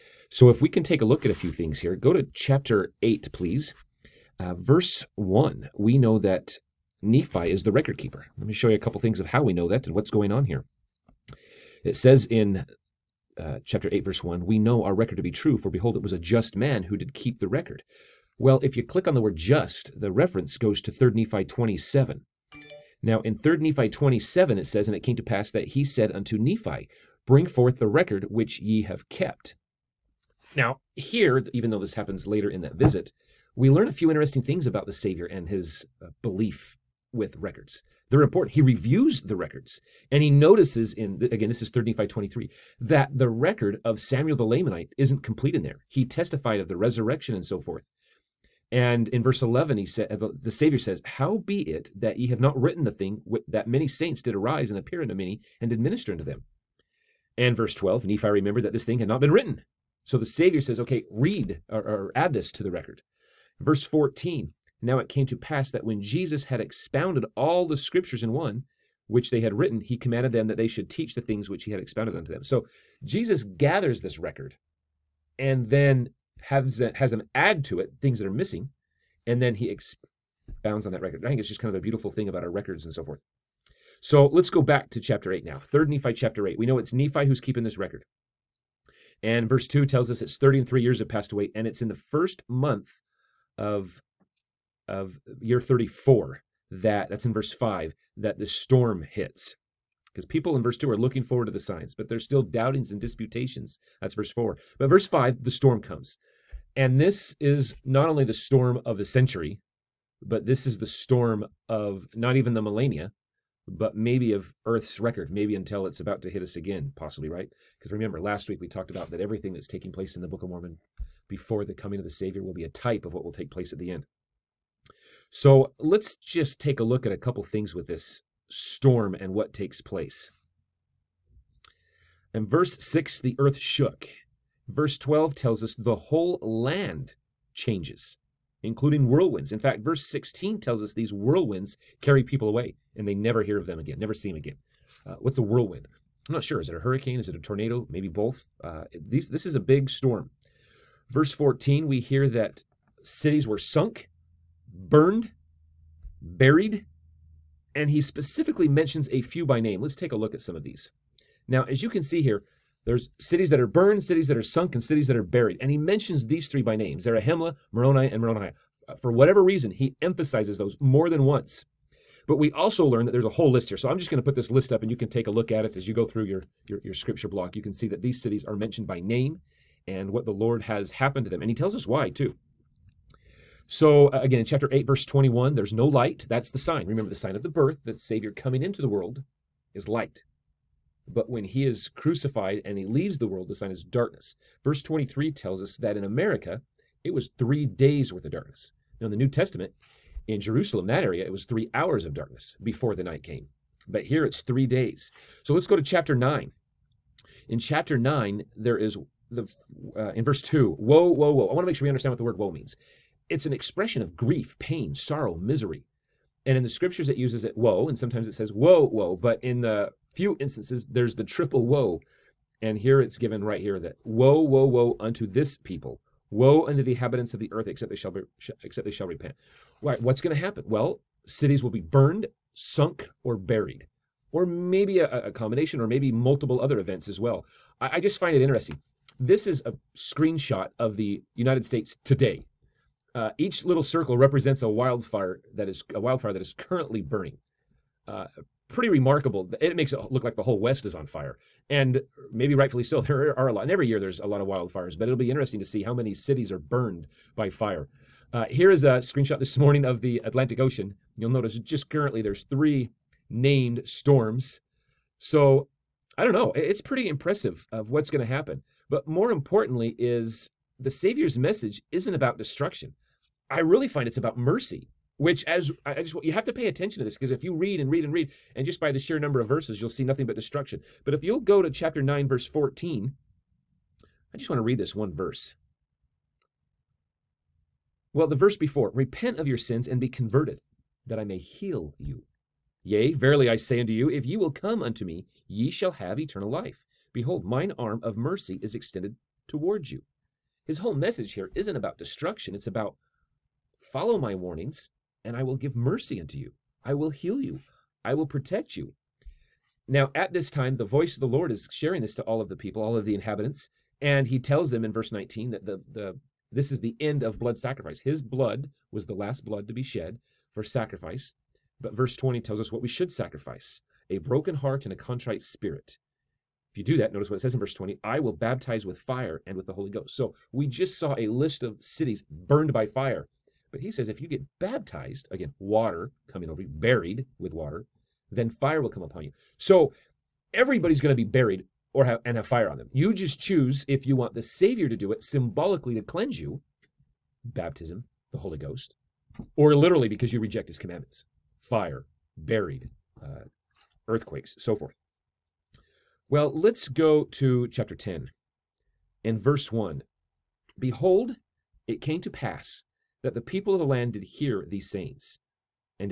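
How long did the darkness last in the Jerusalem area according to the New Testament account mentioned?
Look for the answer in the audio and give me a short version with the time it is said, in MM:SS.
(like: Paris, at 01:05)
3 hours, at 03:21.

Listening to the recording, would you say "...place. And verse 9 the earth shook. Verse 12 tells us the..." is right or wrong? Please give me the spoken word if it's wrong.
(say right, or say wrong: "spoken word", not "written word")
wrong: "6", not "9".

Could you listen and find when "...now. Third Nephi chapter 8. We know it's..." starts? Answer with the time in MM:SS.
01:25.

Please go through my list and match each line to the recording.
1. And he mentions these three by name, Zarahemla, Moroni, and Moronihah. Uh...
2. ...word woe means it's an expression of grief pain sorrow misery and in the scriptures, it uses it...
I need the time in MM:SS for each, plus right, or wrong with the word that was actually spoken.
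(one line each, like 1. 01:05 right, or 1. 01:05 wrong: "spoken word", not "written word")
1. 02:45 right
2. 03:32 right.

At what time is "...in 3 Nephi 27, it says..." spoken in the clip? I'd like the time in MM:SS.
00:23.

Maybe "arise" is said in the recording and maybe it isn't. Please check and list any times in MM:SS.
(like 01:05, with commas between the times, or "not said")
00:54.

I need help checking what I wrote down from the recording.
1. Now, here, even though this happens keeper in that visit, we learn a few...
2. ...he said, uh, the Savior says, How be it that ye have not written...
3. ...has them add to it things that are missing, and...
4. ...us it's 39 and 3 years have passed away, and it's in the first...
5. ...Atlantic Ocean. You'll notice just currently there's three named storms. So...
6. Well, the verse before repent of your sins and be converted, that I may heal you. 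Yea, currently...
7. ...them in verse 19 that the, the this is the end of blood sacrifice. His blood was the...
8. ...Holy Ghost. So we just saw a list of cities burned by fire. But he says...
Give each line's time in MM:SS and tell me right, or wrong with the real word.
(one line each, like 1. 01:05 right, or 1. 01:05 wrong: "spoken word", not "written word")
1. 00:30 wrong: "later", not "keeper"
2. 00:49 right
3. 01:16 right
4. 01:30 wrong: "30", not "39"
5. 04:20 right
6. 04:48 wrong: "verily", not "currently"
7. 05:14 right
8. 05:29 right.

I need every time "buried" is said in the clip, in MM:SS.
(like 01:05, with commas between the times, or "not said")
02:36, 02:45, 03:53, 05:36, 05:41, 05:52.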